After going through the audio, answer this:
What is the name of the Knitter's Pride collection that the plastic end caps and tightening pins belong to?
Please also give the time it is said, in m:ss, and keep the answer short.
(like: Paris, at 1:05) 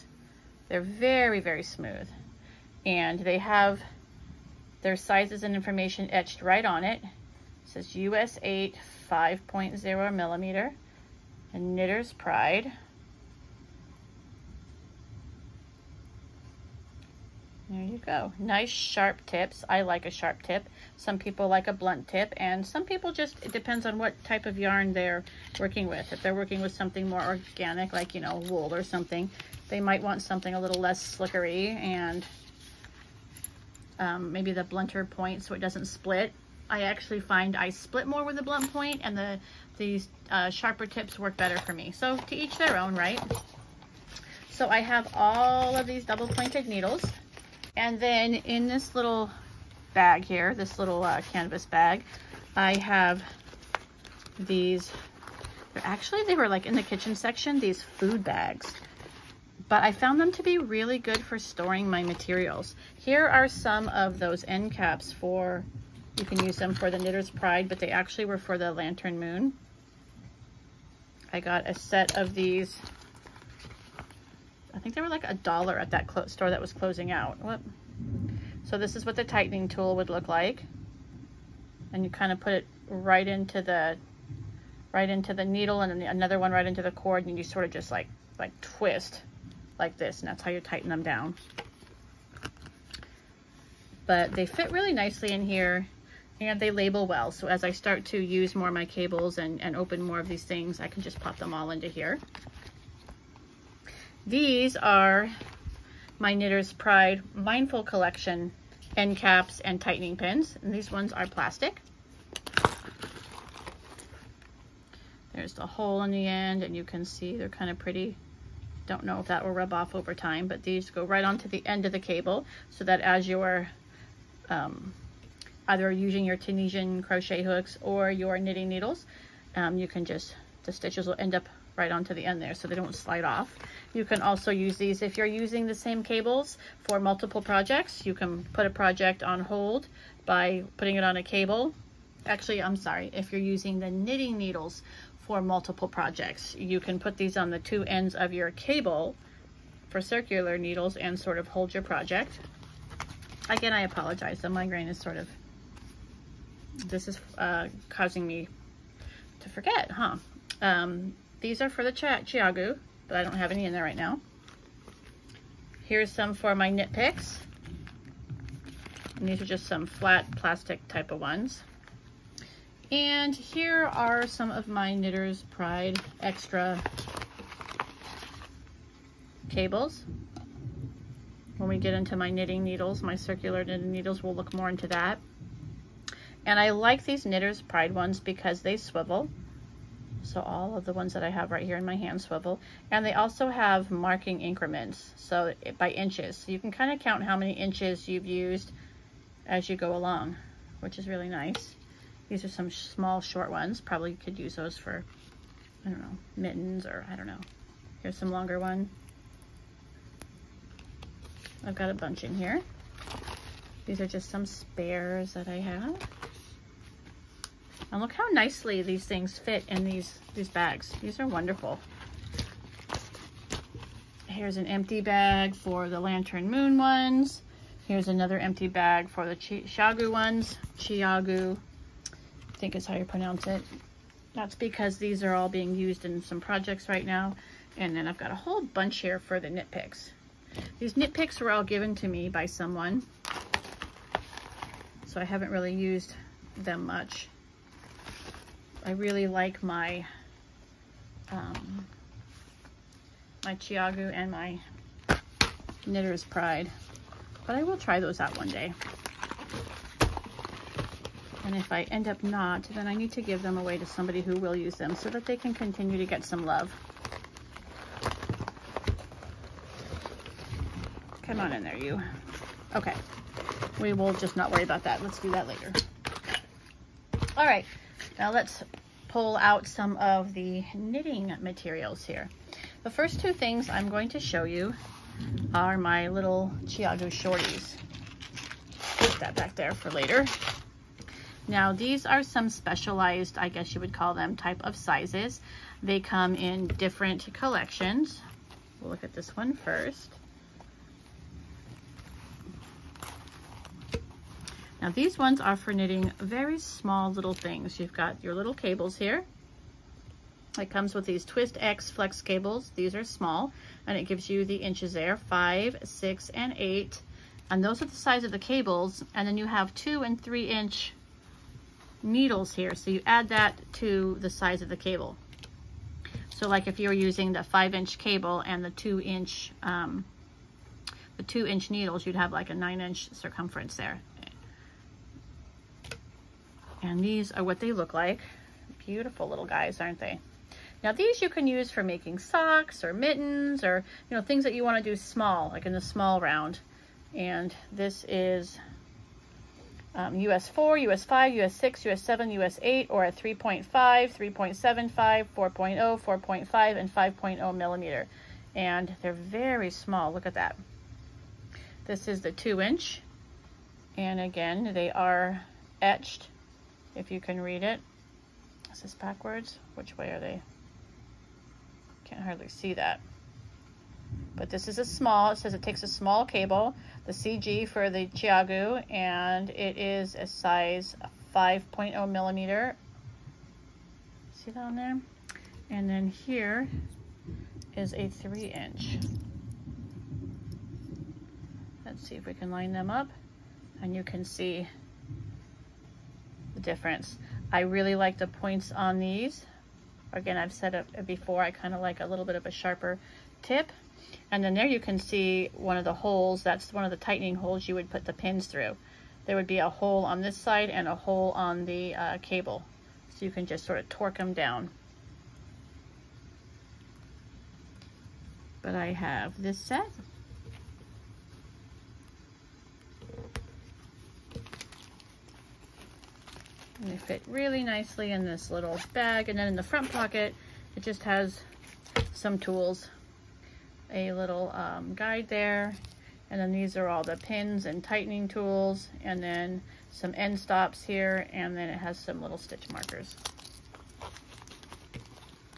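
Mindful Collection, at 1:47.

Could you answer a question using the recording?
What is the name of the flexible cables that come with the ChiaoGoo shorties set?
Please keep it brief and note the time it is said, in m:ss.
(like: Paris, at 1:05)
Twist X flex, at 5:11.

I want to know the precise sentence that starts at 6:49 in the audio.
There would be a hole on this side and a hole on the uh, cable.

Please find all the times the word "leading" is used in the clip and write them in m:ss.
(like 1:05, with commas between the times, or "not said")
not said.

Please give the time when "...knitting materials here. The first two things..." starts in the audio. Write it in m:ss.
4:40.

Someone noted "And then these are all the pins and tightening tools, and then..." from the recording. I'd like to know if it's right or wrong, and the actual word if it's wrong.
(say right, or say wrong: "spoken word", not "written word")
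right.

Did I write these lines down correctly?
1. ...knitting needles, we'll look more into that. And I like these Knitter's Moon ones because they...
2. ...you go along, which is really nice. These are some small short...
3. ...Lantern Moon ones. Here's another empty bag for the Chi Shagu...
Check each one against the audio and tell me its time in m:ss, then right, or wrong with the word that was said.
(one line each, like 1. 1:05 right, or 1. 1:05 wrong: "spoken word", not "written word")
1. 3:03 wrong: "Pride", not "Moon"
2. 3:19 right
3. 3:45 right.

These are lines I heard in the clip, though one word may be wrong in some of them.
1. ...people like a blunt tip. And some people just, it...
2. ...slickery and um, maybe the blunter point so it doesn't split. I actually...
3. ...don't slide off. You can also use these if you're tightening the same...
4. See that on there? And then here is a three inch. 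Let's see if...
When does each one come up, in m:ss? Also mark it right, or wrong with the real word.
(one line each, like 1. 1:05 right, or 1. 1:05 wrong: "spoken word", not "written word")
1. 0:21 right
2. 0:31 right
3. 2:12 wrong: "using", not "tightening"
4. 6:24 right.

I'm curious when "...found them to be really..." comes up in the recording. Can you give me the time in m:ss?
0:59.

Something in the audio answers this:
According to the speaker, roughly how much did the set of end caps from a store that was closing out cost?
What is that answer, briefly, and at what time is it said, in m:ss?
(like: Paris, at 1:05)
a dollar, at 1:15.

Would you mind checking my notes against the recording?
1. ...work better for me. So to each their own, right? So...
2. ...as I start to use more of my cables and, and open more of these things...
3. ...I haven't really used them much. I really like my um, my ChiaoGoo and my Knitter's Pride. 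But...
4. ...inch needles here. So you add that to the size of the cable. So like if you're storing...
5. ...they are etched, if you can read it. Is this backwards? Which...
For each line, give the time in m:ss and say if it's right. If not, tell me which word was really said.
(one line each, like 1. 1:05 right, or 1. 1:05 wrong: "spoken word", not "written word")
1. 0:41 right
2. 1:37 right
3. 4:05 right
4. 5:20 wrong: "using", not "storing"
5. 6:04 right.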